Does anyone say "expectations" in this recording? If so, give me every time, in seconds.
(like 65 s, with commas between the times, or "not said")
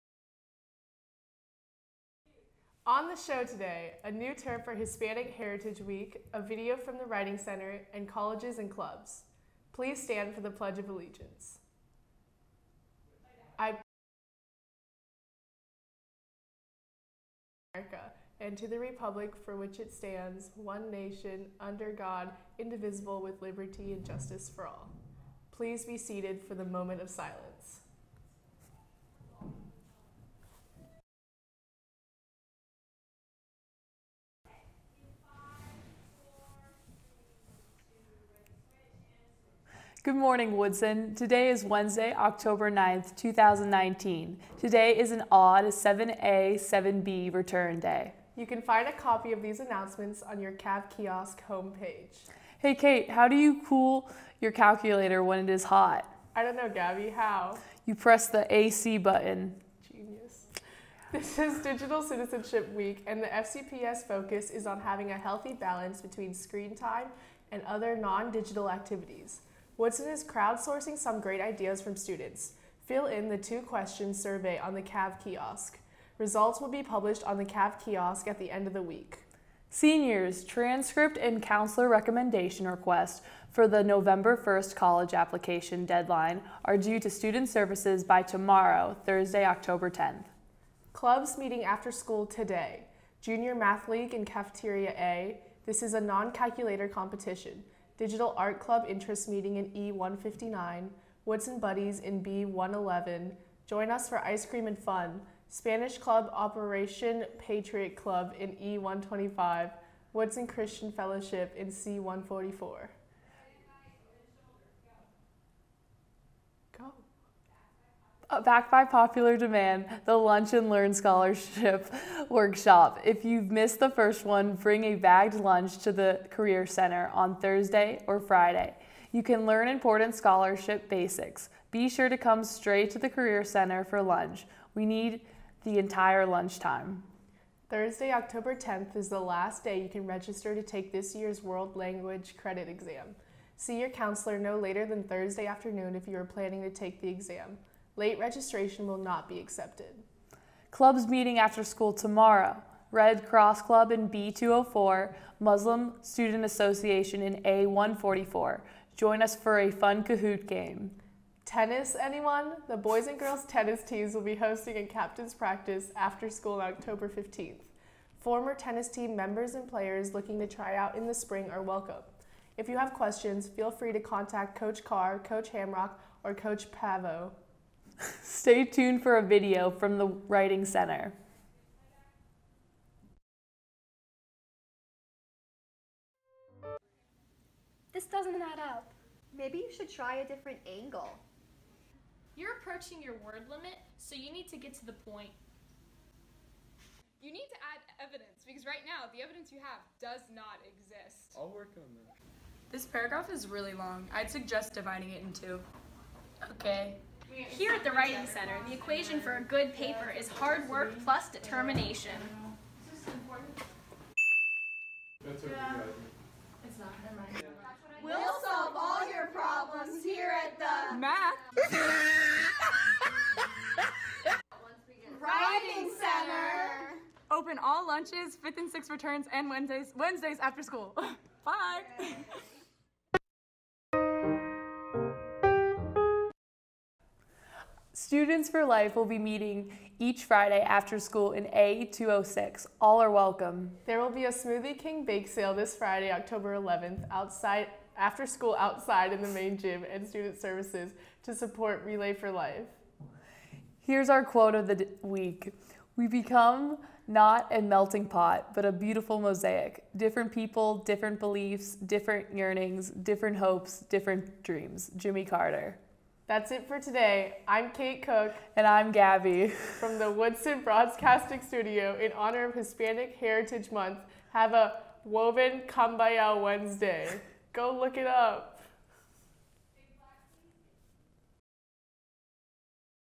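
not said.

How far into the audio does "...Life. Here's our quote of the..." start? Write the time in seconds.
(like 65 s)
252 s.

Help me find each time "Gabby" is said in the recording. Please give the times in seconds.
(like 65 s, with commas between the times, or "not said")
56 s, 268 s.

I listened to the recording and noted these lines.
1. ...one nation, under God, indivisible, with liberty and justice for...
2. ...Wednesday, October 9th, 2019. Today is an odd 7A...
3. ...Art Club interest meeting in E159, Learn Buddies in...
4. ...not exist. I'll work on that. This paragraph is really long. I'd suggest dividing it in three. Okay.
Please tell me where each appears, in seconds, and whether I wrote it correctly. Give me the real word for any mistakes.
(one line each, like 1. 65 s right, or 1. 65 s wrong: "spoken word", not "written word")
1. 20 s right
2. 41 s right
3. 98 s wrong: "Woodson", not "Learn"
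4. 200 s wrong: "two", not "three".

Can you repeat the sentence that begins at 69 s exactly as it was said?
Woodson is crowdsourcing some great ideas from students.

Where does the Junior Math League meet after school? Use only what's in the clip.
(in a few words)
Cafeteria A.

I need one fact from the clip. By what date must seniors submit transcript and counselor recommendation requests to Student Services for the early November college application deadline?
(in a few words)
Thursday, October 10th.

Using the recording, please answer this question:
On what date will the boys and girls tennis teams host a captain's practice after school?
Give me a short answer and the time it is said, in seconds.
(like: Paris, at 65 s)
October 15th, at 166 s.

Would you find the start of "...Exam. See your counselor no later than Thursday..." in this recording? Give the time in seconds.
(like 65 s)
142 s.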